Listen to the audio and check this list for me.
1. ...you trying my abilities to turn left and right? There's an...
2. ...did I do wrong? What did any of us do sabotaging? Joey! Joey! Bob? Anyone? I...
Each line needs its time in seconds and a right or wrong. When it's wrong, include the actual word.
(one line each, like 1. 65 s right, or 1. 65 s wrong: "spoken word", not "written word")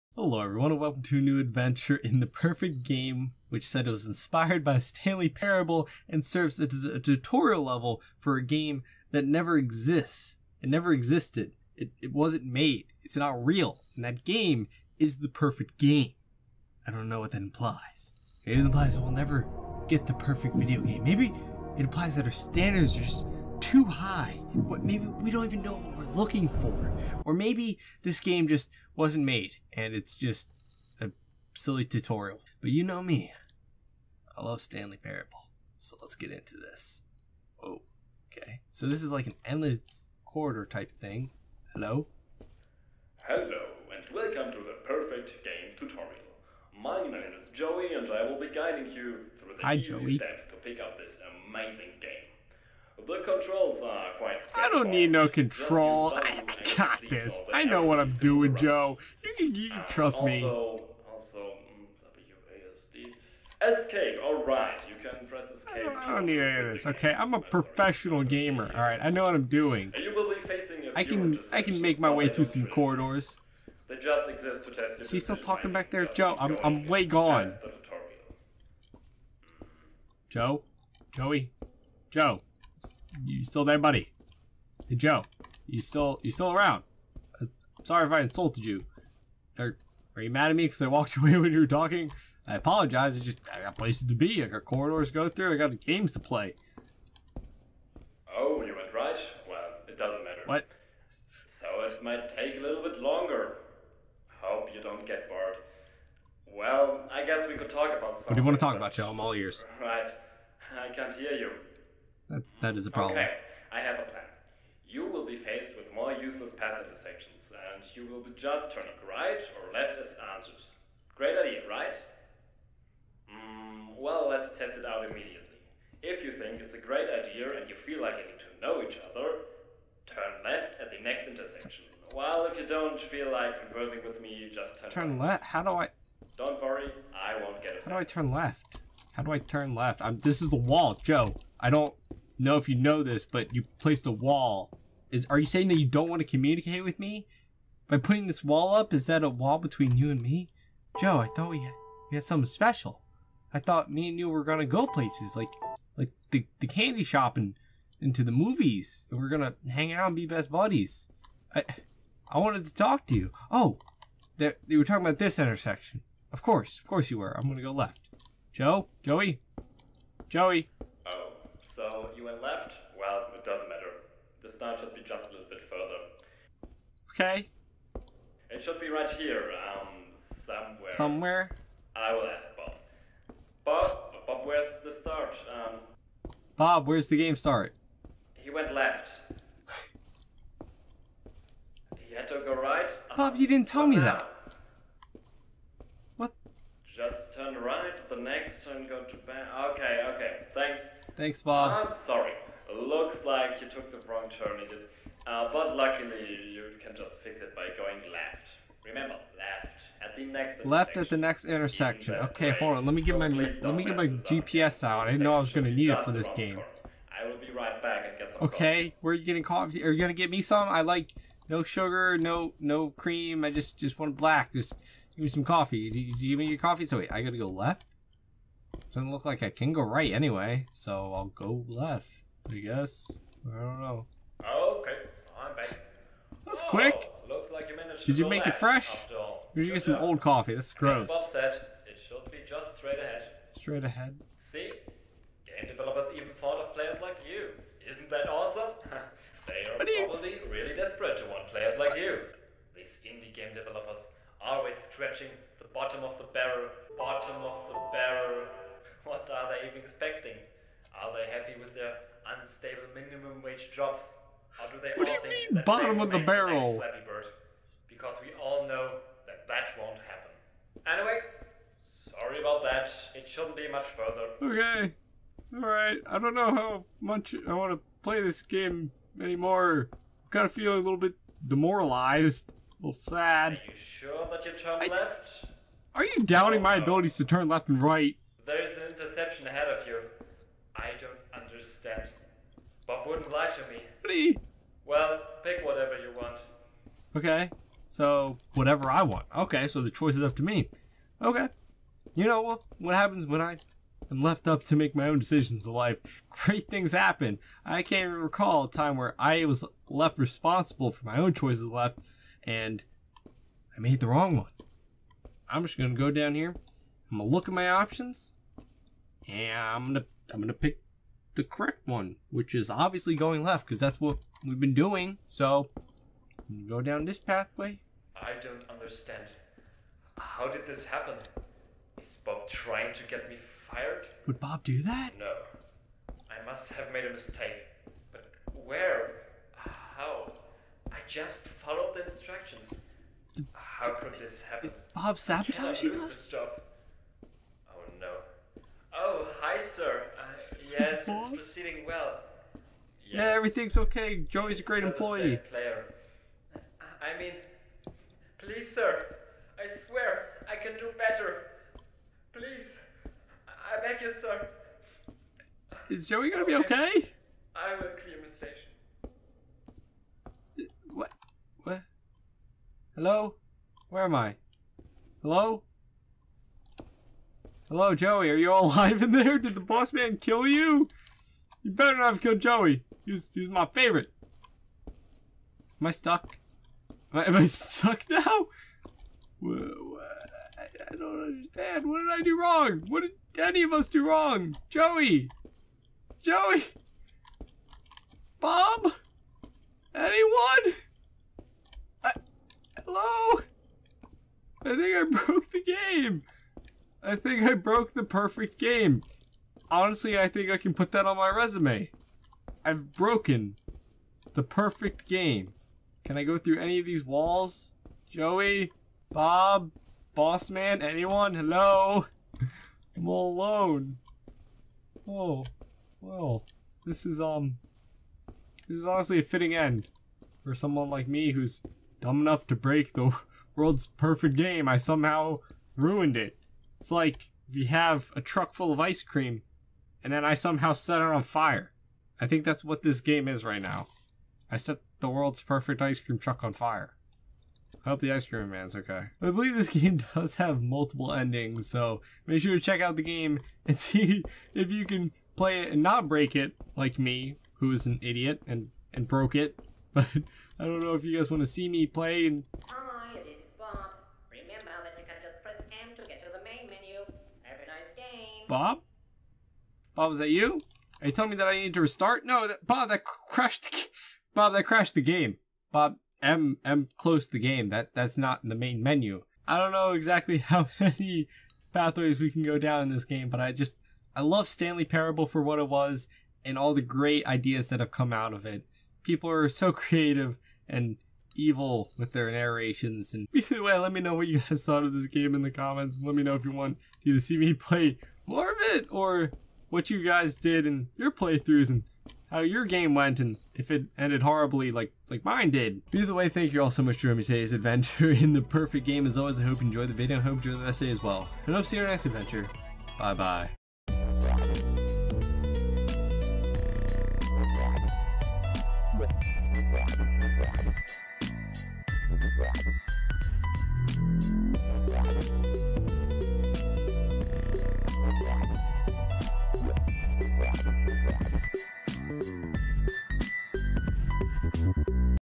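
1. 286 s wrong: "doubting", not "trying"
2. 391 s wrong: "wrong", not "sabotaging".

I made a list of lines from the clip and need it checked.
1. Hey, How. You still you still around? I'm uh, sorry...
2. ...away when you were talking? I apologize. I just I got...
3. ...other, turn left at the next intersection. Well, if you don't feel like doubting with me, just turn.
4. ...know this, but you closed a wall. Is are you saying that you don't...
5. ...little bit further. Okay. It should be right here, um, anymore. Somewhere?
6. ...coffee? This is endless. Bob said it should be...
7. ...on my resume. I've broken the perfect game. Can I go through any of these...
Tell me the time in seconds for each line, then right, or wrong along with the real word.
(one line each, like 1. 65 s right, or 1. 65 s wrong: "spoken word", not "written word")
1. 84 s wrong: "Joe", not "How"
2. 91 s right
3. 129 s wrong: "conversing", not "doubting"
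4. 142 s wrong: "placed", not "closed"
5. 175 s wrong: "somewhere", not "anymore"
6. 240 s wrong: "gross", not "endless"
7. 411 s right.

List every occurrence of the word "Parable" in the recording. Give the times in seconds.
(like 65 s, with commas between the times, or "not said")
5 s, 34 s, 484 s.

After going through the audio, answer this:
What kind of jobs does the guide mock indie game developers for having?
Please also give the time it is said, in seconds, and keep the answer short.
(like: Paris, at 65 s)
Unstable minimum wage jobs, at 262 s.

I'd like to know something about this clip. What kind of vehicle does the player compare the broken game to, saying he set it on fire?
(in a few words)
Ice cream truck.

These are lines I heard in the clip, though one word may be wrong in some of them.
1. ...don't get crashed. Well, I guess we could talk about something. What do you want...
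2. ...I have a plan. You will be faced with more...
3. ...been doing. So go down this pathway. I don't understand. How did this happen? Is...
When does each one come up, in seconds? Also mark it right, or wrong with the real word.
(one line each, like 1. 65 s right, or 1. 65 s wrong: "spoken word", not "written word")
1. 104 s wrong: "bored", not "crashed"
2. 113 s right
3. 324 s right.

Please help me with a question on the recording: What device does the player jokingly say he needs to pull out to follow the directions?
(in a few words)
GPS.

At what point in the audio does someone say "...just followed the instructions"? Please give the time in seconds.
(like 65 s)
341 s.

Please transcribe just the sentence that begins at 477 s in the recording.
That that's not in the main menu.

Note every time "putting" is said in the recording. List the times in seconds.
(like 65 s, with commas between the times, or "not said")
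147 s.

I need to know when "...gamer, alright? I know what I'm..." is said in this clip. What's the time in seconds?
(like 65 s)
68 s.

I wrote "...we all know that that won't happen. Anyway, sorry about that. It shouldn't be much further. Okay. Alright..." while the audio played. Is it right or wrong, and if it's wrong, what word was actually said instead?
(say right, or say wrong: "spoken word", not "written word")
right.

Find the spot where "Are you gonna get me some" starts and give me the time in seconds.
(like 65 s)
219 s.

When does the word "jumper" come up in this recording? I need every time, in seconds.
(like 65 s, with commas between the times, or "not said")
not said.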